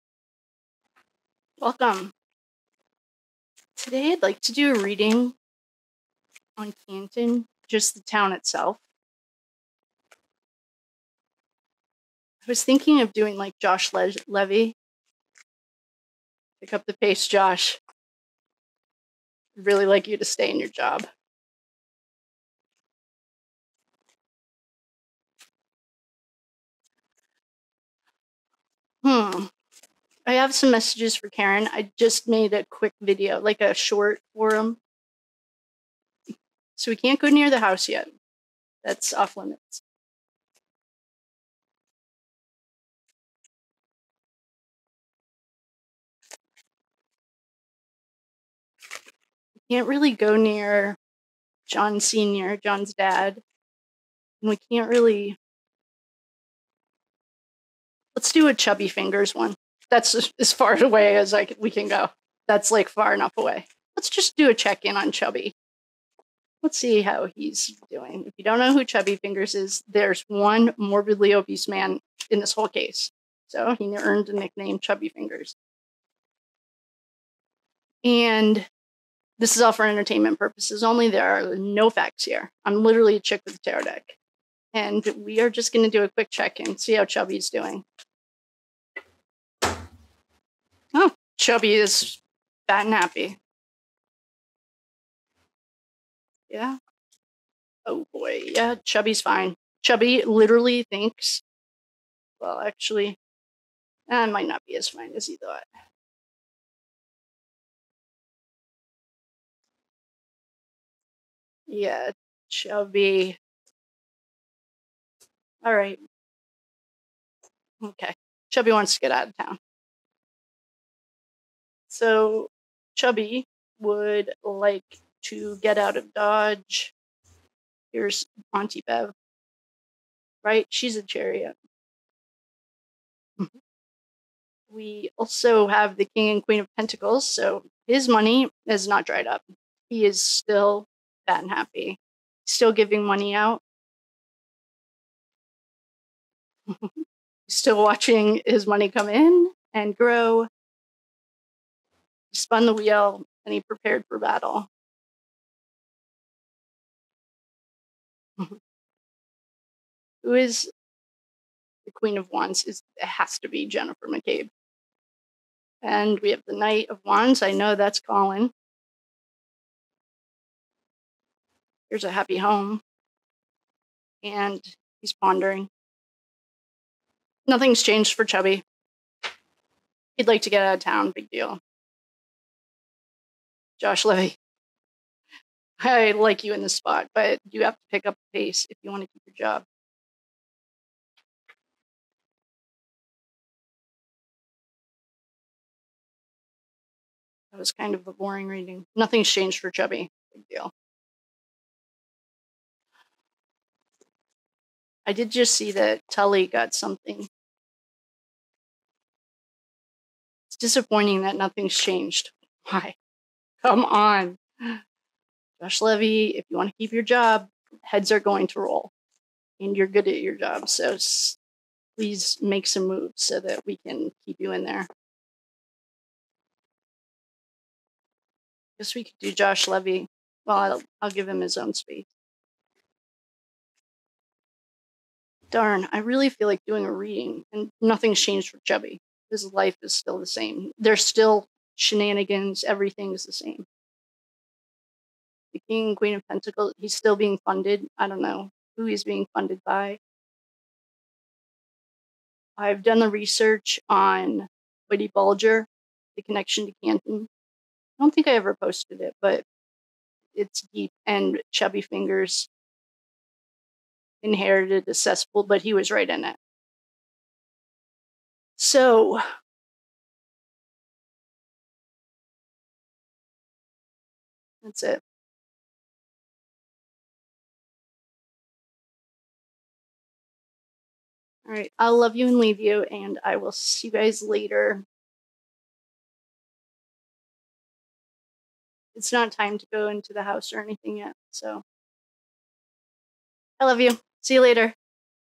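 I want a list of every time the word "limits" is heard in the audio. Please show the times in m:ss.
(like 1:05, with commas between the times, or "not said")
0:39.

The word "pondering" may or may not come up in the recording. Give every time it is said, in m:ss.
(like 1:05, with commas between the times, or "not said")
2:55.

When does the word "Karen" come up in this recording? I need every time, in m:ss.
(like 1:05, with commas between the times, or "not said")
0:31.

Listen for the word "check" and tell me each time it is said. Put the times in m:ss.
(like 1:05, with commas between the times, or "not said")
1:04, 1:26.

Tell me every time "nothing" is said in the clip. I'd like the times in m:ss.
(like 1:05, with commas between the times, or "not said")
2:57, 3:18, 3:31, 3:57.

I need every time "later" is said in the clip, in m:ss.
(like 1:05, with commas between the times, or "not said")
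4:44, 4:54.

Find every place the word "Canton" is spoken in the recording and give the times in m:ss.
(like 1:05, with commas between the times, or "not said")
0:06, 4:16.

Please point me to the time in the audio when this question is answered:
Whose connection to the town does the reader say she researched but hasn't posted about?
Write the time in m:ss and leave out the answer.
4:14.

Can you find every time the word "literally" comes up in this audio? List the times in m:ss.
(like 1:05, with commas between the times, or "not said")
1:22, 1:40.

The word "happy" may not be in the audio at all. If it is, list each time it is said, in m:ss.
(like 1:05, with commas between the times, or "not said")
1:32, 2:21, 2:52.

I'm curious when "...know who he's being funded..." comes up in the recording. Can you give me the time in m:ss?
4:08.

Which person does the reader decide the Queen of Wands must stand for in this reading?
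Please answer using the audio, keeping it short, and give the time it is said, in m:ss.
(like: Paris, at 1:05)
Jennifer McCabe, at 2:43.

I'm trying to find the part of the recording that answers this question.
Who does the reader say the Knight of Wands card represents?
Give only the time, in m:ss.
2:47.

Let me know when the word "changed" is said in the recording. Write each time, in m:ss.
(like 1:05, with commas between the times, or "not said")
2:57, 3:19, 3:31, 3:58.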